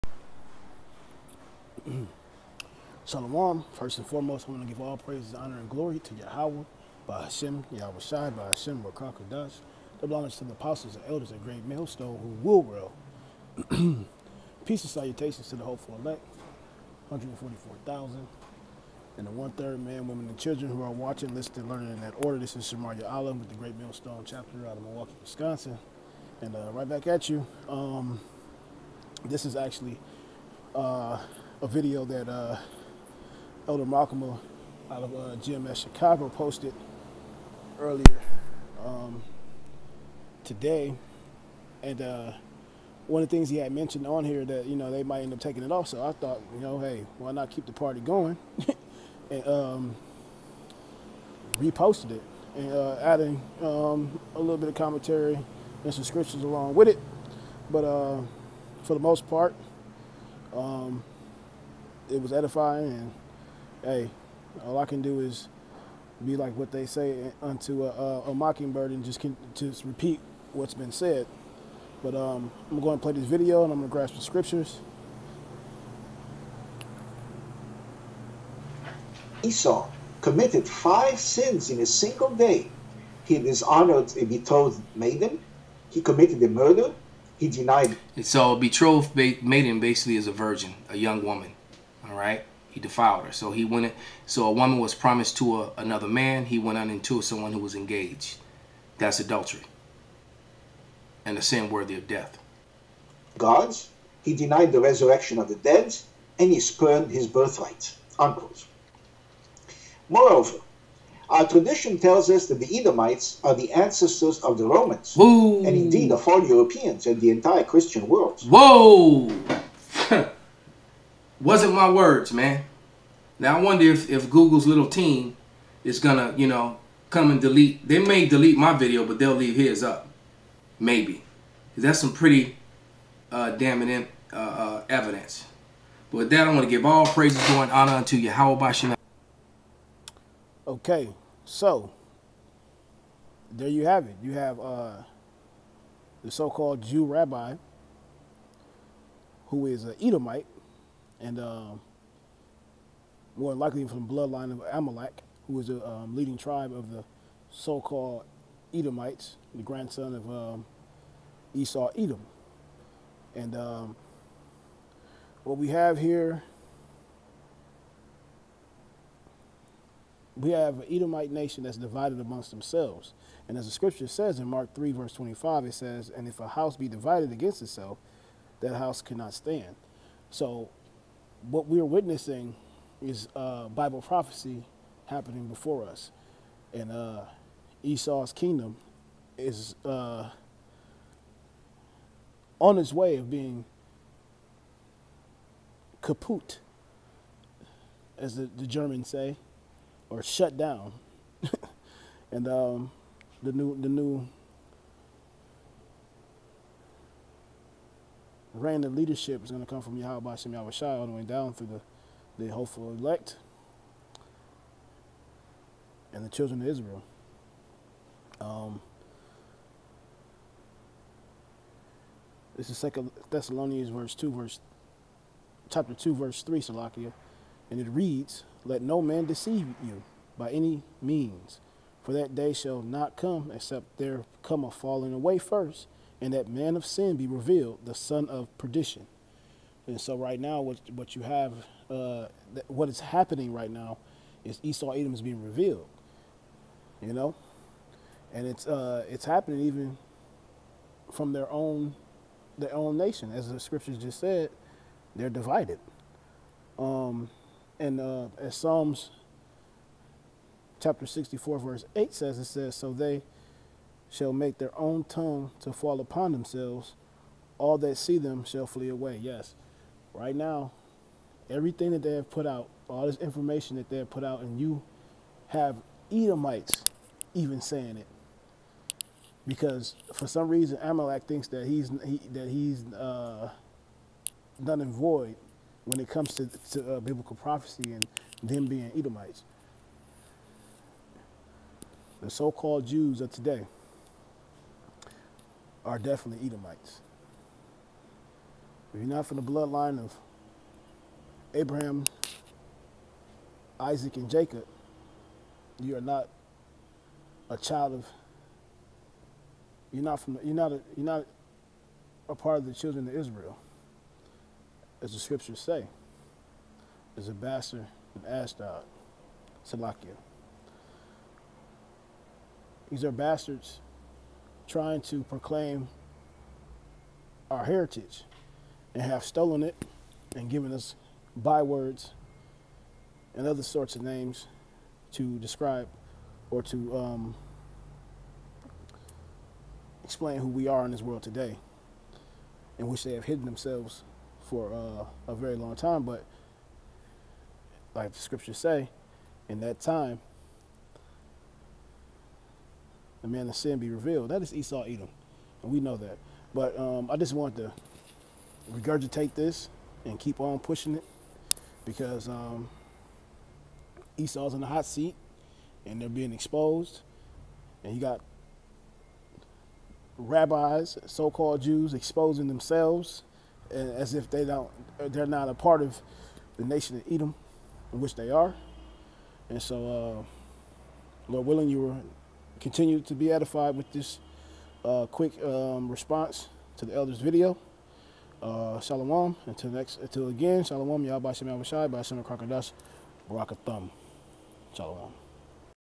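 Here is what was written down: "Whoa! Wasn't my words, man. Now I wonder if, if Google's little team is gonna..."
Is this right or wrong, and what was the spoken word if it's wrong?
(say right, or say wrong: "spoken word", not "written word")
right.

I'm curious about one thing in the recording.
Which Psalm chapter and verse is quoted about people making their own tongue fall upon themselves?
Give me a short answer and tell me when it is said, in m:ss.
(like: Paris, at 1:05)
Psalms 64:8, at 4:18.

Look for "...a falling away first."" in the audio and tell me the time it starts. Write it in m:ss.
3:54.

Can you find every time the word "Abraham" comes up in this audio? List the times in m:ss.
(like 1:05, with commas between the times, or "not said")
5:01.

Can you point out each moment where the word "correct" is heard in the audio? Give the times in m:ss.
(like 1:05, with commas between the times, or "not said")
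not said.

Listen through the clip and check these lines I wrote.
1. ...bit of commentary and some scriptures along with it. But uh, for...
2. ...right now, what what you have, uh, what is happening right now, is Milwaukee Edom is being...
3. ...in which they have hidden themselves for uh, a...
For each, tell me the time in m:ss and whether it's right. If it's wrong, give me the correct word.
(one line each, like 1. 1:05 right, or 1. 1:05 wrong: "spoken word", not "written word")
1. 0:54 right
2. 4:00 wrong: "Esau", not "Milwaukee"
3. 5:42 right.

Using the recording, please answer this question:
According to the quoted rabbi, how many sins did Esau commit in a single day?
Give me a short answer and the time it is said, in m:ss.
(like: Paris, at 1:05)
5, at 1:20.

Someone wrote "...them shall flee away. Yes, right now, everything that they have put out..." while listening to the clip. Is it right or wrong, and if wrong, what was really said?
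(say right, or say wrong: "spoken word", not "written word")
right.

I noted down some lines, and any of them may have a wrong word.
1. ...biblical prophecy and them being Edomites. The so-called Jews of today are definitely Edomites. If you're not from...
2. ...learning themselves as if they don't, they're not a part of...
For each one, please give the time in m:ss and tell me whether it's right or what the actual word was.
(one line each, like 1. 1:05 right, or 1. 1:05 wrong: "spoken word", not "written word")
1. 4:46 right
2. 6:11 wrong: "exposing", not "learning".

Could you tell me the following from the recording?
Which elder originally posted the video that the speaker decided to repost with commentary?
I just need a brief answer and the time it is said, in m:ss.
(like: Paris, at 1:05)
Elder Malcolm, at 0:33.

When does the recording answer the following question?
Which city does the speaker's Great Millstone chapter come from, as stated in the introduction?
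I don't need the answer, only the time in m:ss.
0:24.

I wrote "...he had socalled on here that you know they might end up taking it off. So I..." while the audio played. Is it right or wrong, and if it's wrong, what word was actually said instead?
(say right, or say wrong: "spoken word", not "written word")
wrong: "mentioned", not "socalled".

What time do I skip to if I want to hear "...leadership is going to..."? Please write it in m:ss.
3:28.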